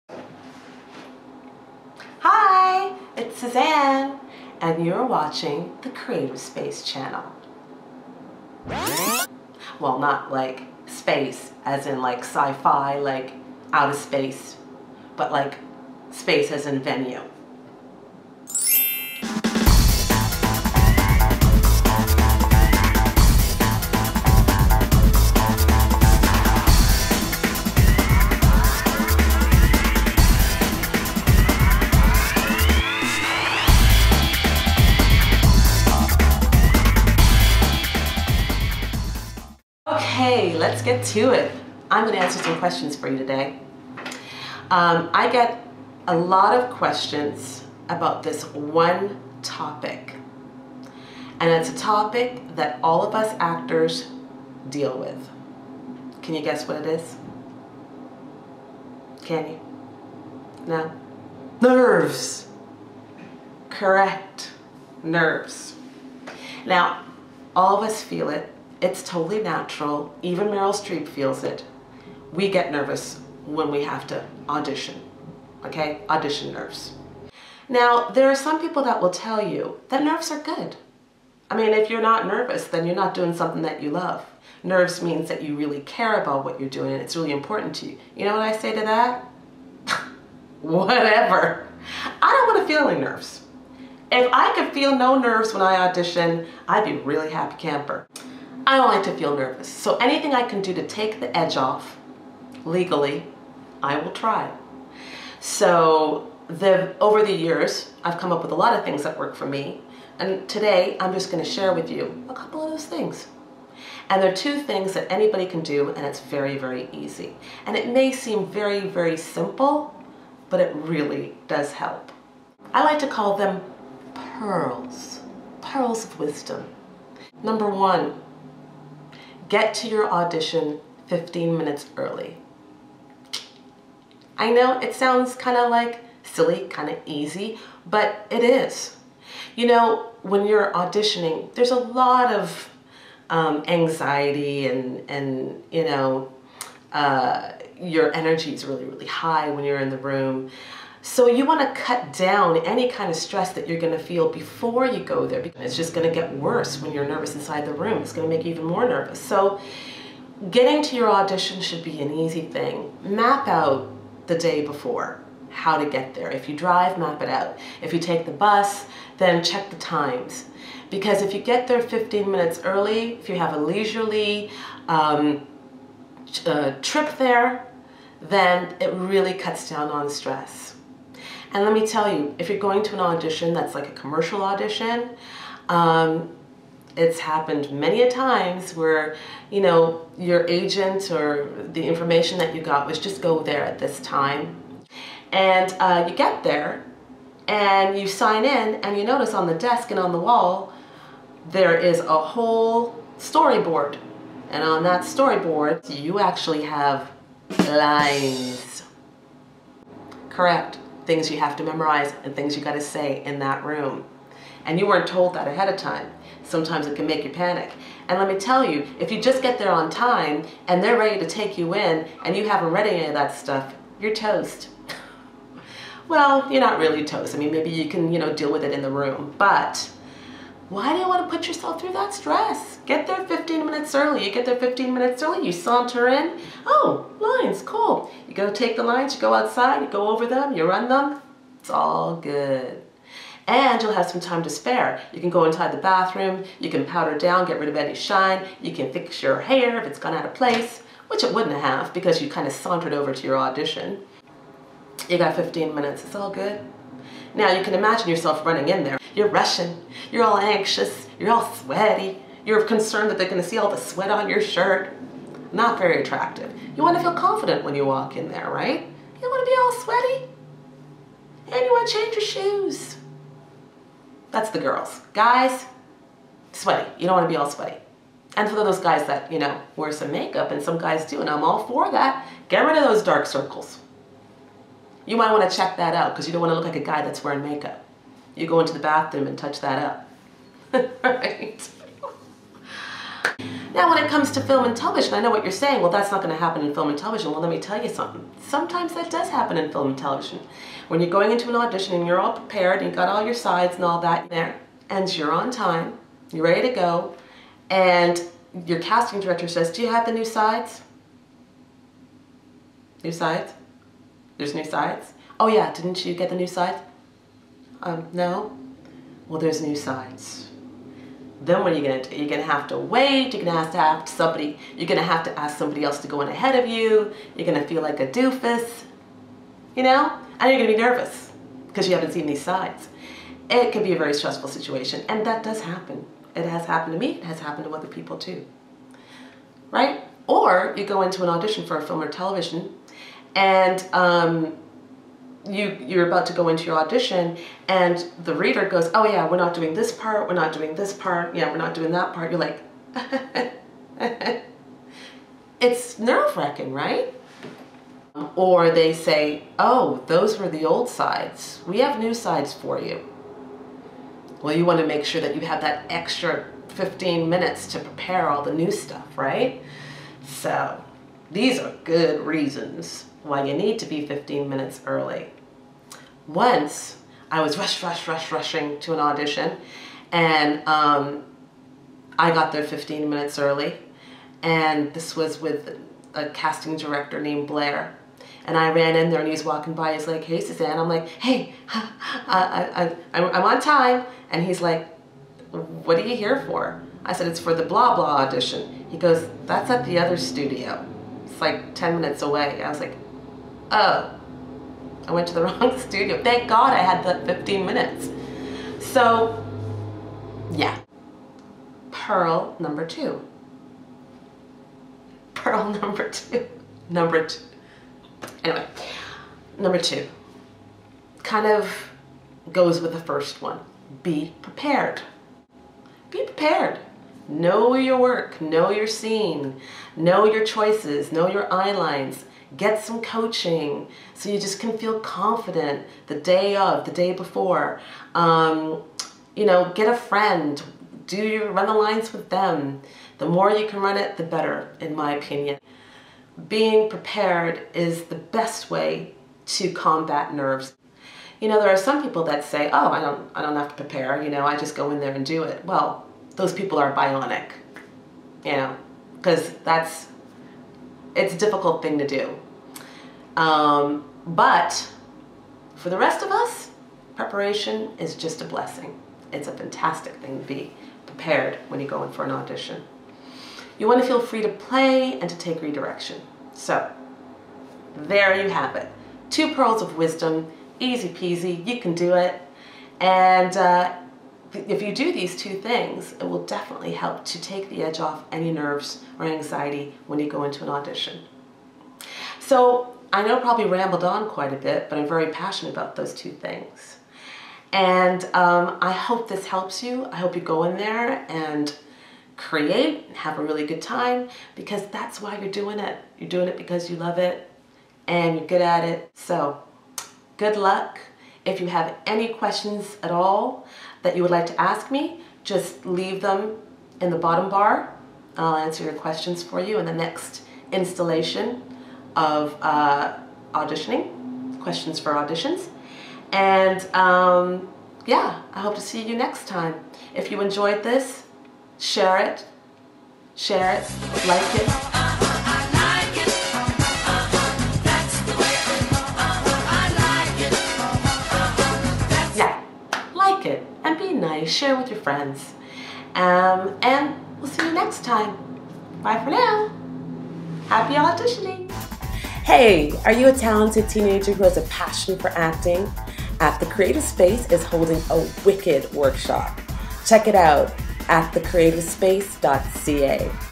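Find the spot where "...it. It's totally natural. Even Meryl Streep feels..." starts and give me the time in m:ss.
1:08.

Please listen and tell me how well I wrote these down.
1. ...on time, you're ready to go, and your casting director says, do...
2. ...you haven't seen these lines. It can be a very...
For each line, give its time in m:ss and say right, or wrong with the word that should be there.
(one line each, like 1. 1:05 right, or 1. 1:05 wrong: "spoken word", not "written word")
1. 5:05 right
2. 5:31 wrong: "sides", not "lines".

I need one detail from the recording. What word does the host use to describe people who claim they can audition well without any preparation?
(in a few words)
bionic.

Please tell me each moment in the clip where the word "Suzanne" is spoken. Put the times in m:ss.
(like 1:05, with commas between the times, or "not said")
0:03, 6:30.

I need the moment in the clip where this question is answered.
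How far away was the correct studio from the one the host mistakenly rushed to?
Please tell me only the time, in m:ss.
6:41.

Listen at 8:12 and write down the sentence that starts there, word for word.
So I know I probably rambled on quite a bit, but I'm very passionate about those two things.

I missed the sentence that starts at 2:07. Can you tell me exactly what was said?
Number one, get to your audition 15 minutes early.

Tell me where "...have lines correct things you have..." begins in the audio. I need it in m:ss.
3:26.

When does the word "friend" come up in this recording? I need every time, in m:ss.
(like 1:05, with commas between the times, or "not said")
7:19, 9:04.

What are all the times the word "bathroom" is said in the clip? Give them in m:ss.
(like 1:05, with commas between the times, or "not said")
4:05, 4:48.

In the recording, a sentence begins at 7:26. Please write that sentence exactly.
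Being prepared is the best way to combat nerves.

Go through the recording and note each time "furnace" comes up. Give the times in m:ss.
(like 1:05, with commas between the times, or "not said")
not said.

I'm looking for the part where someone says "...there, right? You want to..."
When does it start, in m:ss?
4:28.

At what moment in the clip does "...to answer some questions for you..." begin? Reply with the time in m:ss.
0:42.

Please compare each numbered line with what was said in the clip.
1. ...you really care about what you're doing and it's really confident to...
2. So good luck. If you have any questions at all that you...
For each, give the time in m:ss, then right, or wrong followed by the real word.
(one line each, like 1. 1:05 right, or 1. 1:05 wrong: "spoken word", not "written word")
1. 1:25 wrong: "important", not "confident"
2. 8:29 right.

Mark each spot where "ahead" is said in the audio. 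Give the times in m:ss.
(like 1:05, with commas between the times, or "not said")
3:35, 5:26.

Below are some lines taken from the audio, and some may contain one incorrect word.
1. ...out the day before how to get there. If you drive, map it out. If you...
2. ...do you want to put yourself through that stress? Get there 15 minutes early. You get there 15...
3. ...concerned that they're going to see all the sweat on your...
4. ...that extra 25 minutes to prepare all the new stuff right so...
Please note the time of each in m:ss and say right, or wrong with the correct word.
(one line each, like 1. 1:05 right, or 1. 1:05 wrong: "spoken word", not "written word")
1. 2:43 right
2. 3:50 right
3. 4:22 right
4. 6:05 wrong: "15", not "25".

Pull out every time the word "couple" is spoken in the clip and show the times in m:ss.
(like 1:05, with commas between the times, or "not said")
1:52.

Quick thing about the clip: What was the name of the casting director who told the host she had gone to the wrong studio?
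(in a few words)
Blair.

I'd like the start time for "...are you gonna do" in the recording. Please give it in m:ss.
5:21.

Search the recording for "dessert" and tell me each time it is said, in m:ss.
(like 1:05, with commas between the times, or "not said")
not said.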